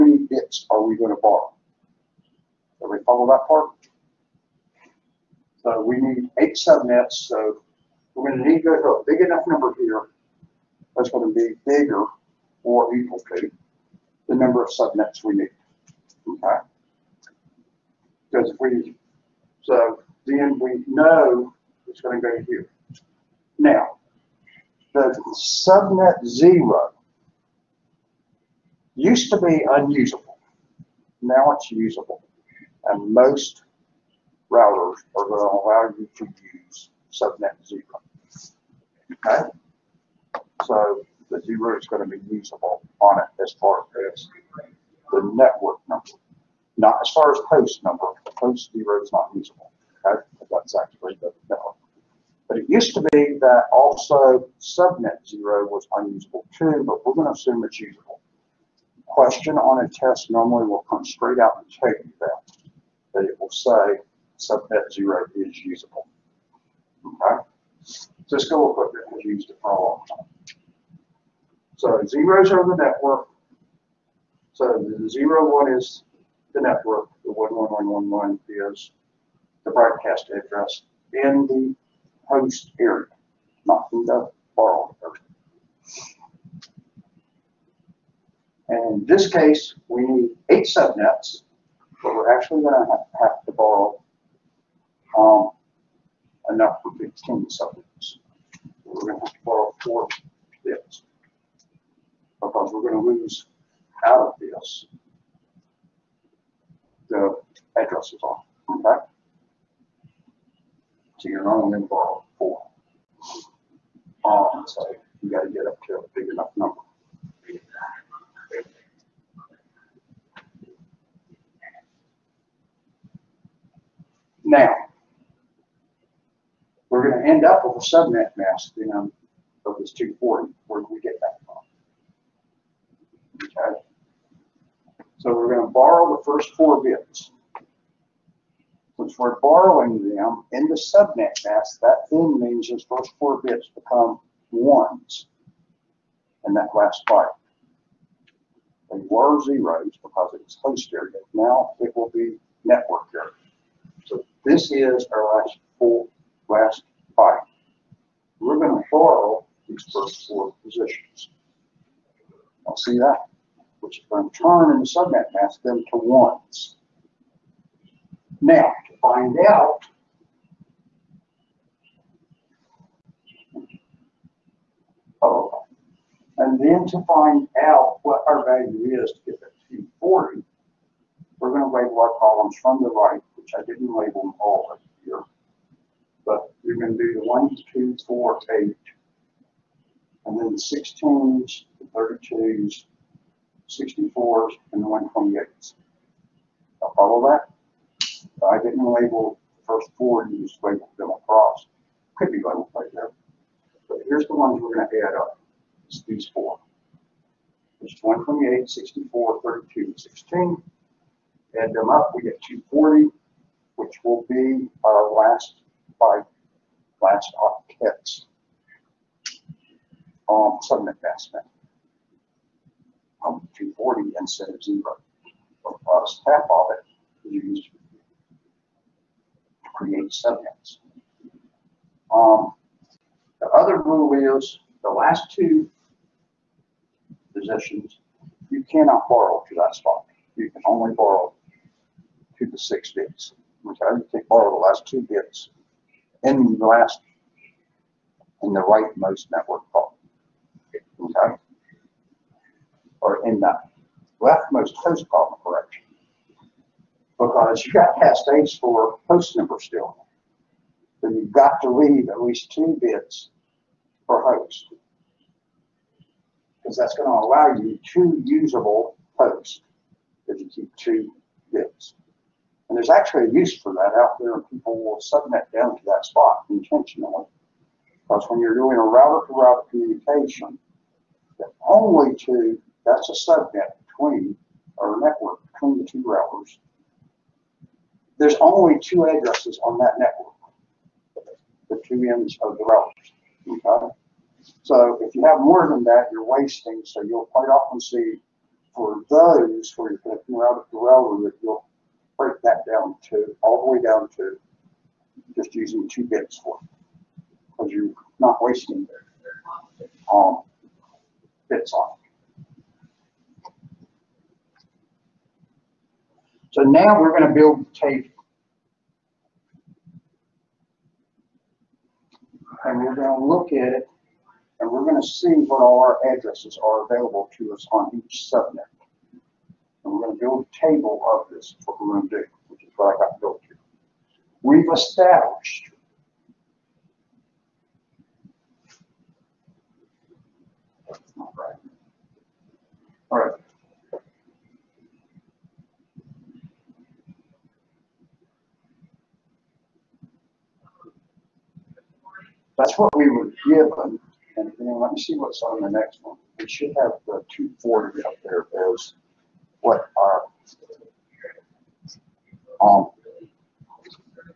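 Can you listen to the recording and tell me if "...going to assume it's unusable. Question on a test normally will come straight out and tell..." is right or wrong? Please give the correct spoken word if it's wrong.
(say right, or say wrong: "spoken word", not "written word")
wrong: "usable", not "unusable".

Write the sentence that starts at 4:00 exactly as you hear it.
You can only borrow to the six bits.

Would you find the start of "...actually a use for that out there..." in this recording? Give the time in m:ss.
4:32.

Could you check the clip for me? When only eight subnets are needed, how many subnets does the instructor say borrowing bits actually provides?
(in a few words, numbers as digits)
15.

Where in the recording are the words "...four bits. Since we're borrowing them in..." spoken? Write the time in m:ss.
2:16.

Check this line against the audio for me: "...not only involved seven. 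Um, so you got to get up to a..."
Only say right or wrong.
wrong.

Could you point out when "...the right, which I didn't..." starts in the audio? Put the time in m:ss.
3:02.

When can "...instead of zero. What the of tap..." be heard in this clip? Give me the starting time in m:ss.
3:44.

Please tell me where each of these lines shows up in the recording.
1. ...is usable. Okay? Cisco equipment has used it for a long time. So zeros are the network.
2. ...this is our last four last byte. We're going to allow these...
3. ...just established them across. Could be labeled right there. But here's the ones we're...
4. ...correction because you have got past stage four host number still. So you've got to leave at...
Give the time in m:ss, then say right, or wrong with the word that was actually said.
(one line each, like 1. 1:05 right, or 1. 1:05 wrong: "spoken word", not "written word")
1. 1:05 right
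2. 2:34 wrong: "borrow", not "allow"
3. 3:20 wrong: "labeled", not "established"
4. 4:15 right.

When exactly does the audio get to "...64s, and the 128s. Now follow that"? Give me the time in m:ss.
3:13.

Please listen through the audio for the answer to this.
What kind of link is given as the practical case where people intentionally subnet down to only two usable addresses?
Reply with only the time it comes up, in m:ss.
4:38.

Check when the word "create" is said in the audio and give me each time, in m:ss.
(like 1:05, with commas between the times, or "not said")
3:49.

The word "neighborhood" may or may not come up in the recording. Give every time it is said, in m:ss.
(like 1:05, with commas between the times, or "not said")
not said.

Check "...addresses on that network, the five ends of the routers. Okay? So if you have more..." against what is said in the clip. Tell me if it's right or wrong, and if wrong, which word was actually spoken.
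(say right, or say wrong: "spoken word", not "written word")
wrong: "two", not "five".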